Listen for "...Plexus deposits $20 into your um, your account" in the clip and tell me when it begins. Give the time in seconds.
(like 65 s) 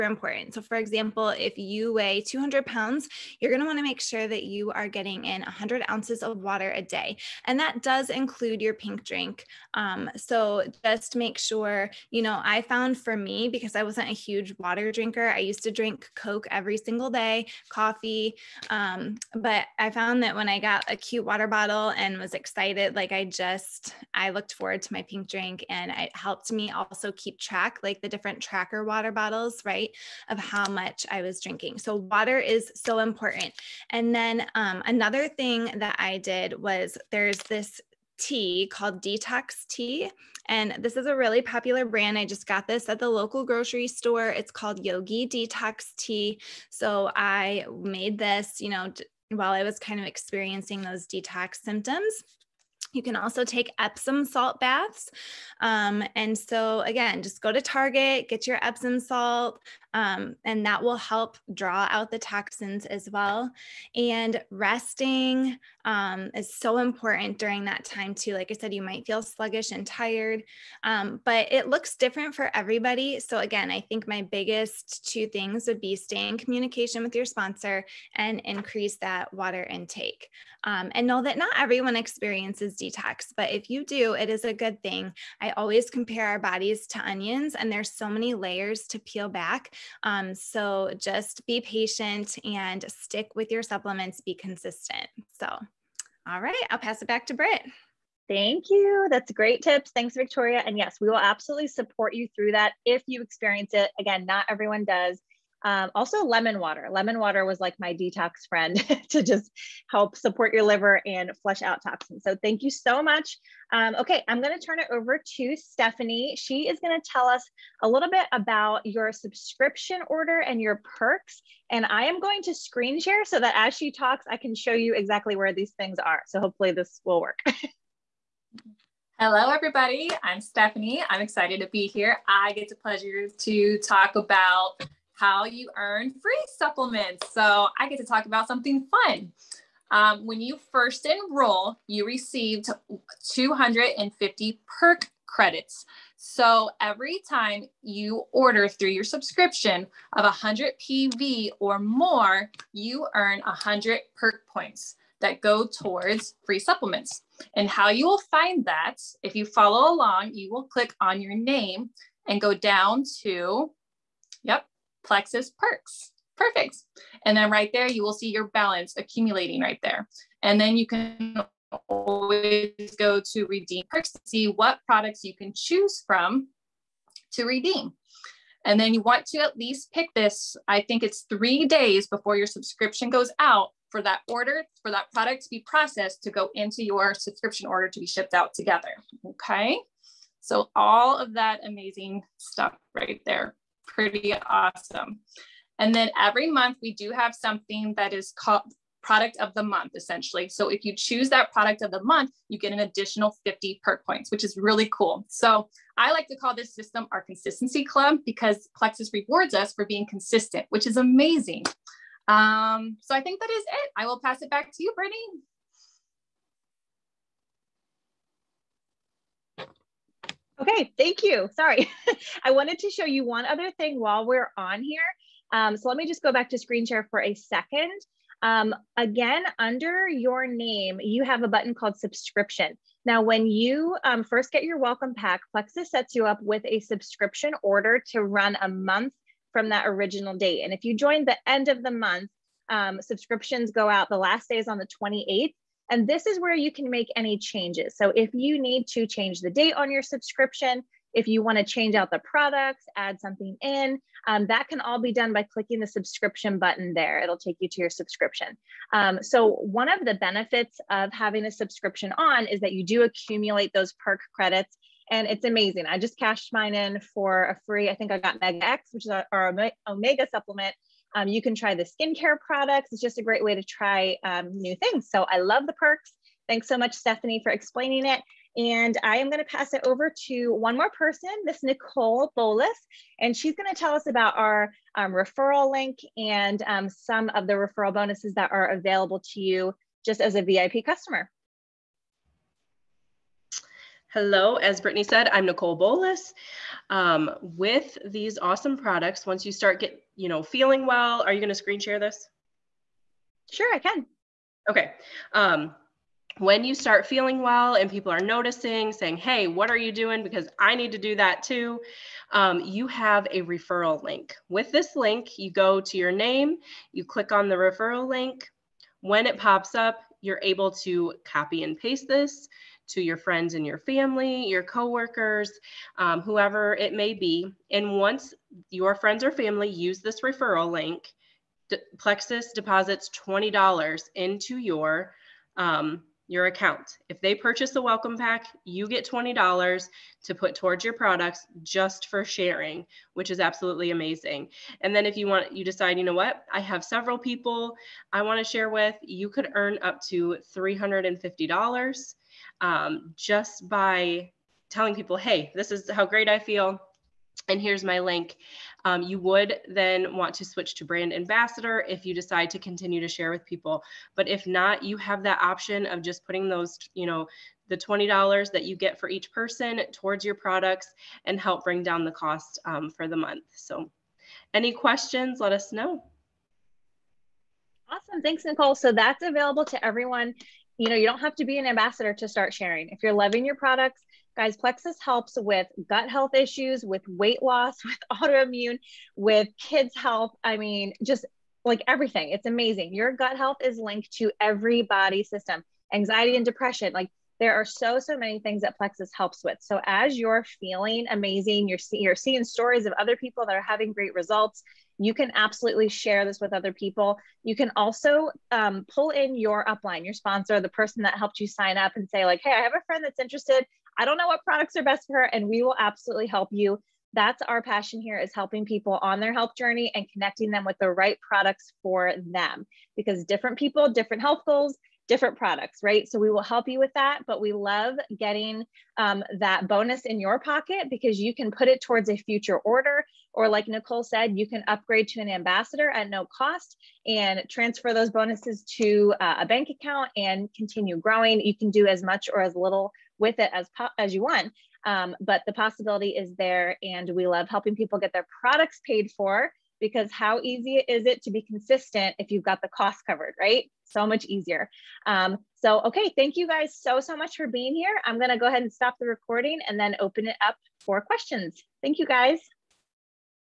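331 s.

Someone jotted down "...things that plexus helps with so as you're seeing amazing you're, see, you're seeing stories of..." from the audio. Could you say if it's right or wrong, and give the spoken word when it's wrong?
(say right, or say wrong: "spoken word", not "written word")
wrong: "feeling", not "seeing".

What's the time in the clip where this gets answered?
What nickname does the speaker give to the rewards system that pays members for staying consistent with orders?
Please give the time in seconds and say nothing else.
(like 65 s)
207 s.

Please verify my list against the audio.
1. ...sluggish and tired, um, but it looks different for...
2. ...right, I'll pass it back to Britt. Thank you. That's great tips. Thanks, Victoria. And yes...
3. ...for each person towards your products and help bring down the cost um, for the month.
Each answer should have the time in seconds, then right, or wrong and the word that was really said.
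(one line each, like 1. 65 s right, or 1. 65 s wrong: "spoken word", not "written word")
1. 69 s right
2. 96 s right
3. 368 s right.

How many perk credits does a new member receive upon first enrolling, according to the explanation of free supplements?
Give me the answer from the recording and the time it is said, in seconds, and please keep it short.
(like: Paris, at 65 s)
250, at 143 s.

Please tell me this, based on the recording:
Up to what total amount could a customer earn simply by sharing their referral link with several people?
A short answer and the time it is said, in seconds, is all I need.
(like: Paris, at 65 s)
$350, at 350 s.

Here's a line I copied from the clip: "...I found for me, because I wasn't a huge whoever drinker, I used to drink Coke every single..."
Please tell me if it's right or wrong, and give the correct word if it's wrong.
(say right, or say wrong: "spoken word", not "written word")
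wrong: "water", not "whoever".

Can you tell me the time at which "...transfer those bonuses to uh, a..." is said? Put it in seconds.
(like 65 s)
437 s.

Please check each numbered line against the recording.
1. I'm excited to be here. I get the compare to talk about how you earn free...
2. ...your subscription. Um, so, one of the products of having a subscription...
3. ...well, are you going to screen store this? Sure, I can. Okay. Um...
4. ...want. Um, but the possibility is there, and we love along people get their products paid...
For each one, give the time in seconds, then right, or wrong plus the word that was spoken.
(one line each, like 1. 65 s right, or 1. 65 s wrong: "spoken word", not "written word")
1. 131 s wrong: "pleasure", not "compare"
2. 257 s wrong: "benefits", not "products"
3. 300 s wrong: "share", not "store"
4. 444 s wrong: "helping", not "along".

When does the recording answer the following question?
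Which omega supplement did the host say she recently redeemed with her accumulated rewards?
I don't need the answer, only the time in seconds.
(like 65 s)
268 s.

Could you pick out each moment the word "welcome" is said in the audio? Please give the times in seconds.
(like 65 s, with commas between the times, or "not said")
234 s, 337 s.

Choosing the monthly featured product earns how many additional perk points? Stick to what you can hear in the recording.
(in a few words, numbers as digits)
50.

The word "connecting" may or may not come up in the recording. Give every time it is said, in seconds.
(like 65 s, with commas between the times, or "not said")
420 s.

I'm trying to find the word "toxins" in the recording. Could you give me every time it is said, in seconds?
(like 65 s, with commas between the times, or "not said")
62 s, 111 s.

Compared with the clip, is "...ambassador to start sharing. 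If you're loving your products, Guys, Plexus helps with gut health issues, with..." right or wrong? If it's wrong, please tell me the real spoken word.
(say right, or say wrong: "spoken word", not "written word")
right.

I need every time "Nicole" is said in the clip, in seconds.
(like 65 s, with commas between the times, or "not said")
281 s, 295 s, 378 s, 433 s.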